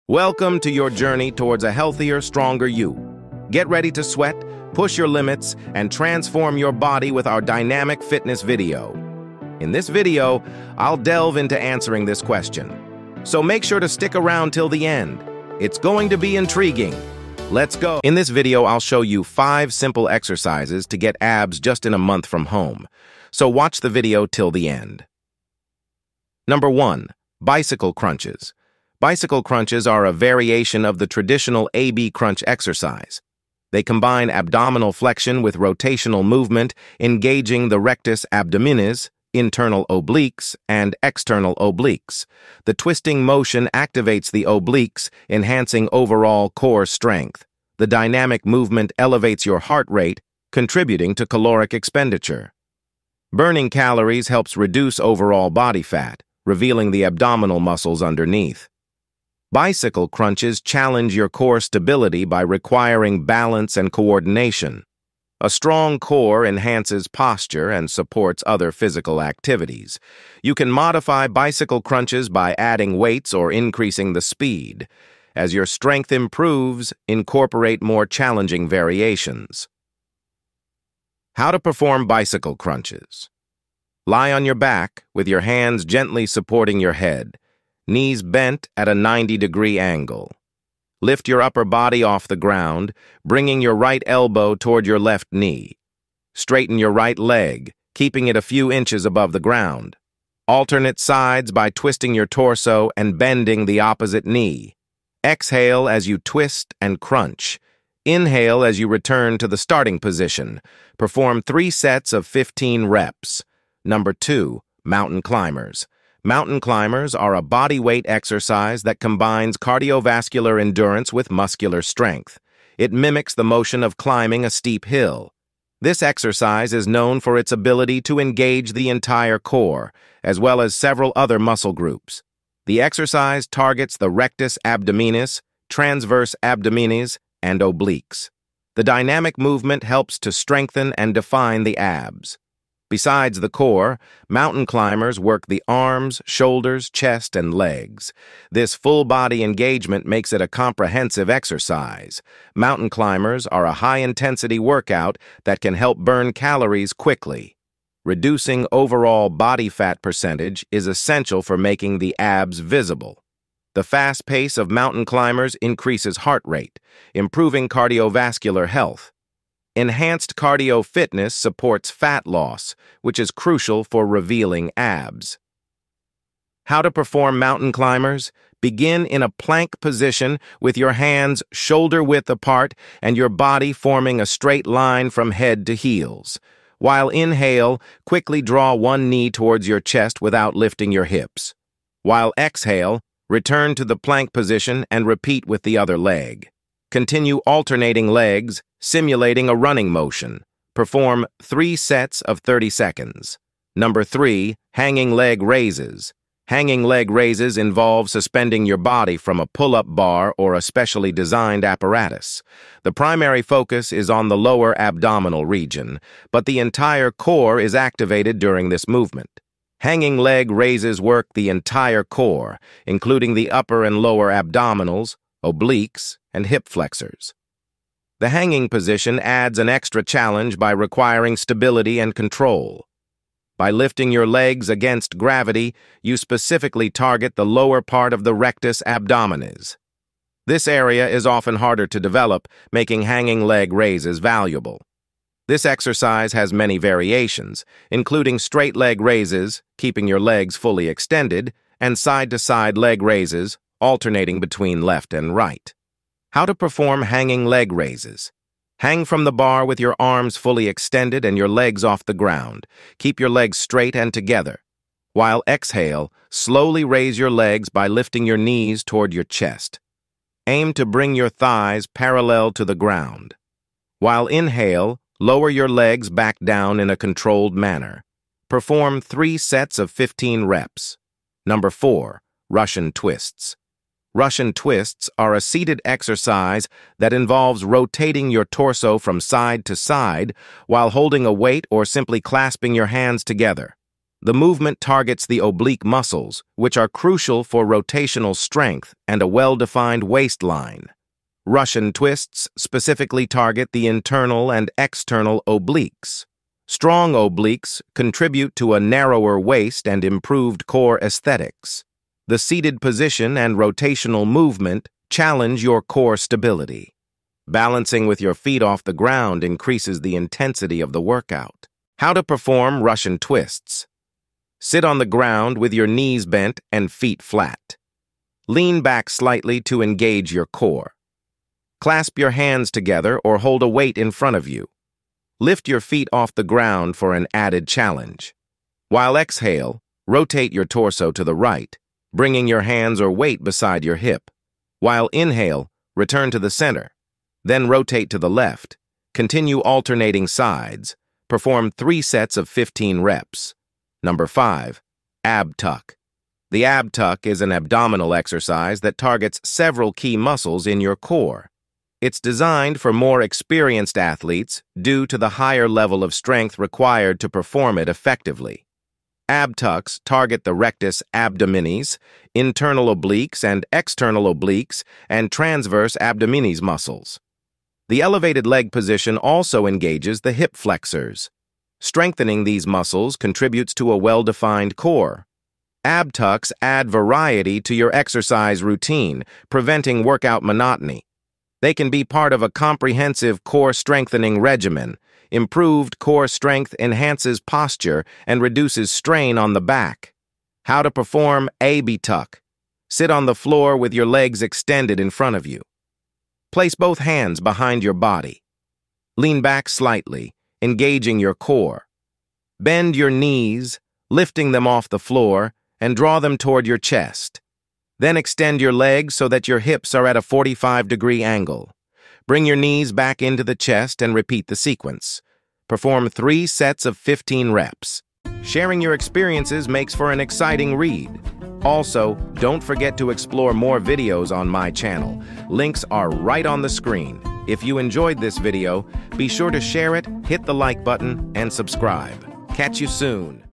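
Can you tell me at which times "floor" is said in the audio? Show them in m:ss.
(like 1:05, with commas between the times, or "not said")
6:43, 6:54.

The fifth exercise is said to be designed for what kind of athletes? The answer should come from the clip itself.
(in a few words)
more experienced.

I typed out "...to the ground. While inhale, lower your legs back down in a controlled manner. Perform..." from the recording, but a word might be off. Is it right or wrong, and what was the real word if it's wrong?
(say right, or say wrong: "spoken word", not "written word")
right.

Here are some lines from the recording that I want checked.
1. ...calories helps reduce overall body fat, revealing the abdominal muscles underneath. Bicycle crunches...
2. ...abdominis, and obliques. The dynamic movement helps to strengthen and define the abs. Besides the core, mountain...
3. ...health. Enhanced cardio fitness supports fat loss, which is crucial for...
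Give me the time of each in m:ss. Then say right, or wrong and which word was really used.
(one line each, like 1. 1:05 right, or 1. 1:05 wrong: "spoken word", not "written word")
1. 0:53 right
2. 2:16 right
3. 2:48 right.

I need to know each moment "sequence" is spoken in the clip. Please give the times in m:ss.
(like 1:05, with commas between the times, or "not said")
7:04.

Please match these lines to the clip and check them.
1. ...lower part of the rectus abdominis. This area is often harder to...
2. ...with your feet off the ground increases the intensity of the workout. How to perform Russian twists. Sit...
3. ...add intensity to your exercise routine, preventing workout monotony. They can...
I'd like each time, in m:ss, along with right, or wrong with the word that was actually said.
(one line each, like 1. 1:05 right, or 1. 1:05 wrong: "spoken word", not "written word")
1. 3:57 right
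2. 5:18 right
3. 6:26 wrong: "variety", not "intensity".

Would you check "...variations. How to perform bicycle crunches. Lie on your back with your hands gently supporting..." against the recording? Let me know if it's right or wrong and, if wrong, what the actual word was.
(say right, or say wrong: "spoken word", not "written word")
right.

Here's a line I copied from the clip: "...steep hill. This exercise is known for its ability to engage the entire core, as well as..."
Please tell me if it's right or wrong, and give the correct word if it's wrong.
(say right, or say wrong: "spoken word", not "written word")
right.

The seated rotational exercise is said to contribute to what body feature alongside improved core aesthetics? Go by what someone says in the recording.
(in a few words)
narrower waist.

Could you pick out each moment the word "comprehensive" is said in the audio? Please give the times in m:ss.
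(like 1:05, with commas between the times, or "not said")
2:30, 6:32.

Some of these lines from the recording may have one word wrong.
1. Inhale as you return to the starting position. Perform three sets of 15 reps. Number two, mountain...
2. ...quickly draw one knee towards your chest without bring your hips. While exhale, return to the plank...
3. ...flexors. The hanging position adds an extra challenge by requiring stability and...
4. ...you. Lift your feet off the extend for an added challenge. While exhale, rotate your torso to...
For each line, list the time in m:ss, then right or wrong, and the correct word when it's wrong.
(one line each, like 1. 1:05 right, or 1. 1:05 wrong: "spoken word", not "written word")
1. 1:48 right
2. 3:08 wrong: "lifting", not "bring"
3. 3:46 right
4. 5:34 wrong: "ground", not "extend".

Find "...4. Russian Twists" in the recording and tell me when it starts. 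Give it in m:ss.
4:41.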